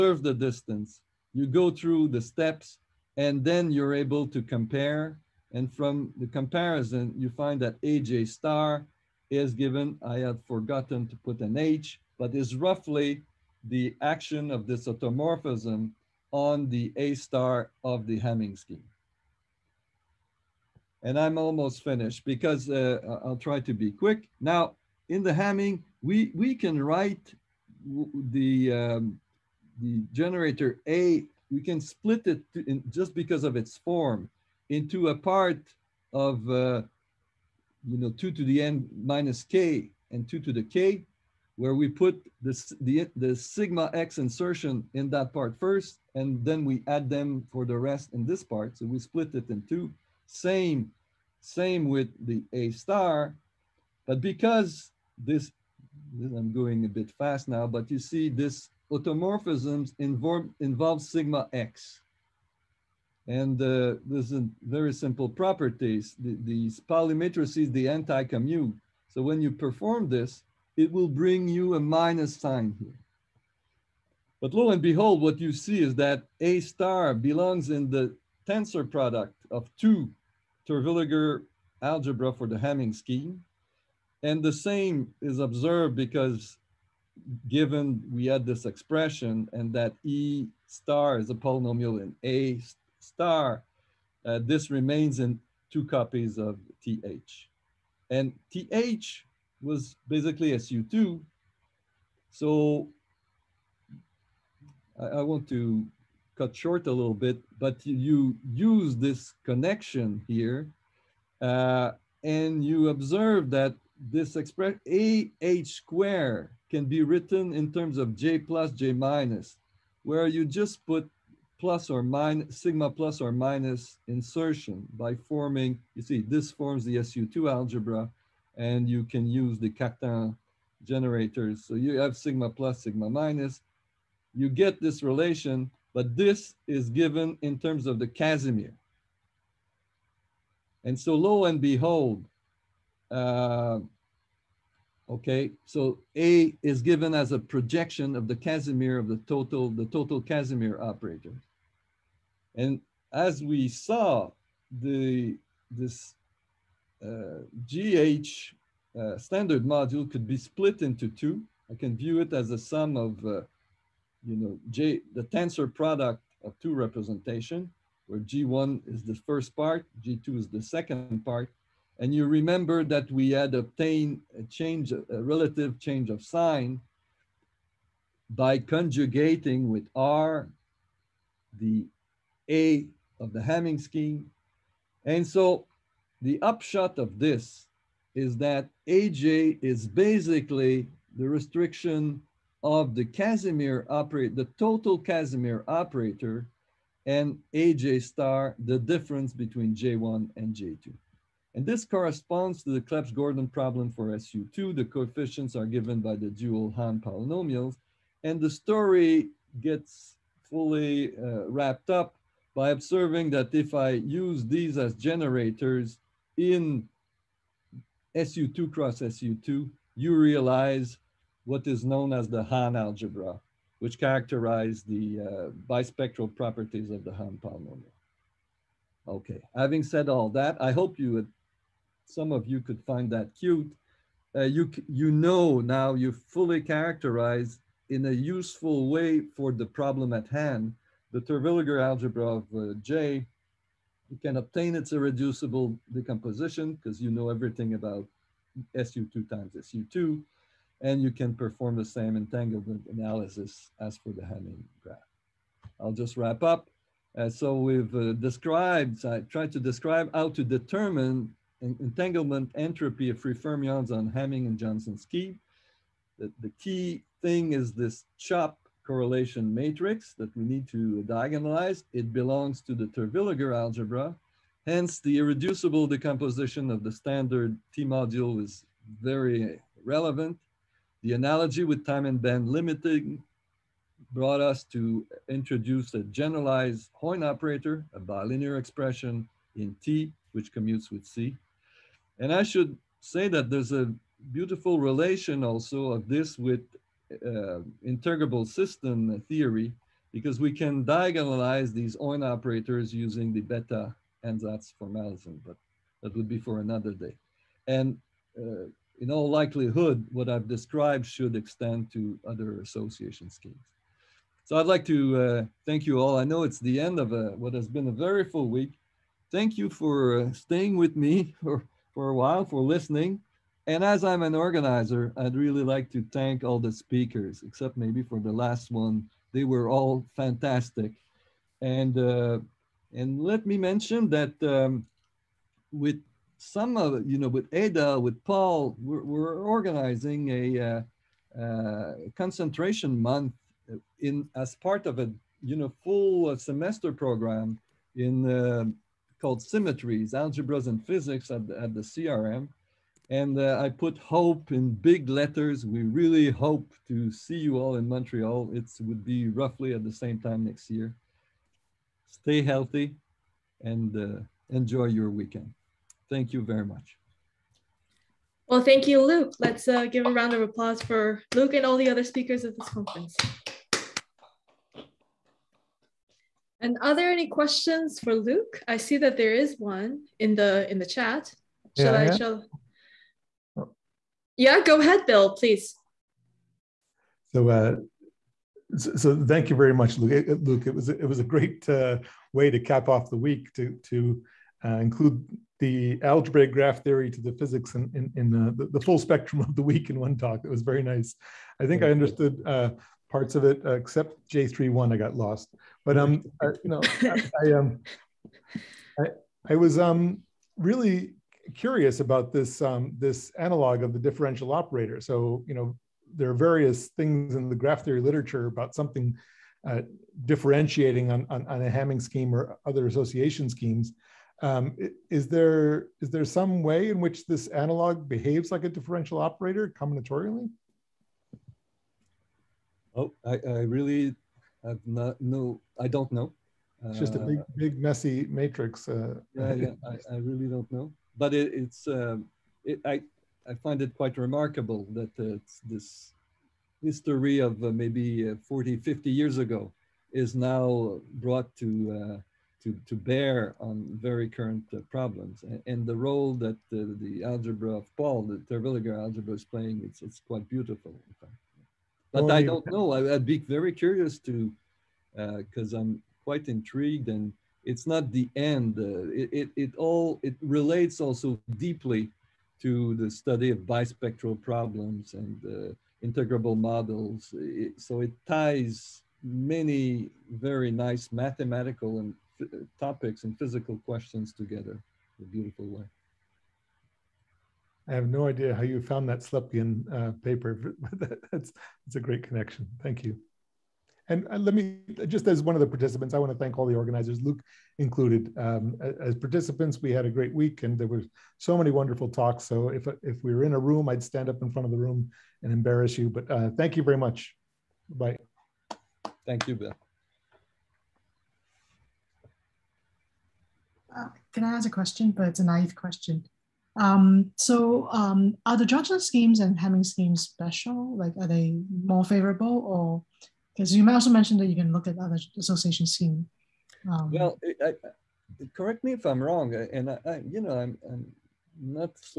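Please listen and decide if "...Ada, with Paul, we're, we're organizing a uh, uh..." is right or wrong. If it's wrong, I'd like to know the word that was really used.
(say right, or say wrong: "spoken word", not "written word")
right.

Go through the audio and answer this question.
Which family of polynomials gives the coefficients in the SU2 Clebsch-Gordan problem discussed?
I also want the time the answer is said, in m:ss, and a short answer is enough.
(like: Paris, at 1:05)
Dual Hahn polynomials, at 3:26.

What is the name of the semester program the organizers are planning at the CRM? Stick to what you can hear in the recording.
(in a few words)
Symmetries, algebras and physics.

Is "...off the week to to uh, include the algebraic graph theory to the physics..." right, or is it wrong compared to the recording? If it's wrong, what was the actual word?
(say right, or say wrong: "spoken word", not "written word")
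right.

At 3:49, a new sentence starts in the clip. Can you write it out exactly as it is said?
Okay, having said all that, I hope you would, some of you could find that cute.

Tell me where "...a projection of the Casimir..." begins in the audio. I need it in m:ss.
2:27.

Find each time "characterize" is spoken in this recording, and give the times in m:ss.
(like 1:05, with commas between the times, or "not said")
3:43, 3:56.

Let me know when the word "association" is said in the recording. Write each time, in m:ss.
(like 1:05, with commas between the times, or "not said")
5:12, 7:02, 8:45.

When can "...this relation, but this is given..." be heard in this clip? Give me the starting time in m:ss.
2:14.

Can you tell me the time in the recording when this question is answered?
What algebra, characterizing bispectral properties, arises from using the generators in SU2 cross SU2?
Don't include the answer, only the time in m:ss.
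3:42.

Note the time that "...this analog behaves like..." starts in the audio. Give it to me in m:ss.
7:07.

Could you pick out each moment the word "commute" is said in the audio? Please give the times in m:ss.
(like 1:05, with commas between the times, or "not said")
1:07, 4:50.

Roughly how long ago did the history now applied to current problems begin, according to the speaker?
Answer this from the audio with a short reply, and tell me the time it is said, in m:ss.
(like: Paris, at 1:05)
40, 50 years ago, at 7:28.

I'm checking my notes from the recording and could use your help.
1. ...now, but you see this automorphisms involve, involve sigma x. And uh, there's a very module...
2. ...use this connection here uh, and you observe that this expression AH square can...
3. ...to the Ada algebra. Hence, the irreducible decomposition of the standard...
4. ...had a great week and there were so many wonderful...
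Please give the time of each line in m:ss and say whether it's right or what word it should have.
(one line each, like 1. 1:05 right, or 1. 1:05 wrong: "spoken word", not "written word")
1. 0:57 wrong: "simple", not "module"
2. 1:48 right
3. 4:32 wrong: "Terwilliger", not "Ada"
4. 8:19 right.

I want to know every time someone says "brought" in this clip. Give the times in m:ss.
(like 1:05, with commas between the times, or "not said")
4:44, 7:31.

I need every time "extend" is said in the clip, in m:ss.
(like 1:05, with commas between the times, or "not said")
5:11.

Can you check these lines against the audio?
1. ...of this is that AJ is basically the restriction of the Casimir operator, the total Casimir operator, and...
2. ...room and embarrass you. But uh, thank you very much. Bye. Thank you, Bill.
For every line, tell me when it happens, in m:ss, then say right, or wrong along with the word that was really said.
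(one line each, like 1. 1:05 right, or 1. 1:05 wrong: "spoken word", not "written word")
1. 3:06 right
2. 8:24 right.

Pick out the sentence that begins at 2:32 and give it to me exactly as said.
And as we saw, the this uh, GH uh, standard module could be split into two.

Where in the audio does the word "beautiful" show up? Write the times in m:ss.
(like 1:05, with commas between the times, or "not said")
4:54, 7:40, 8:05.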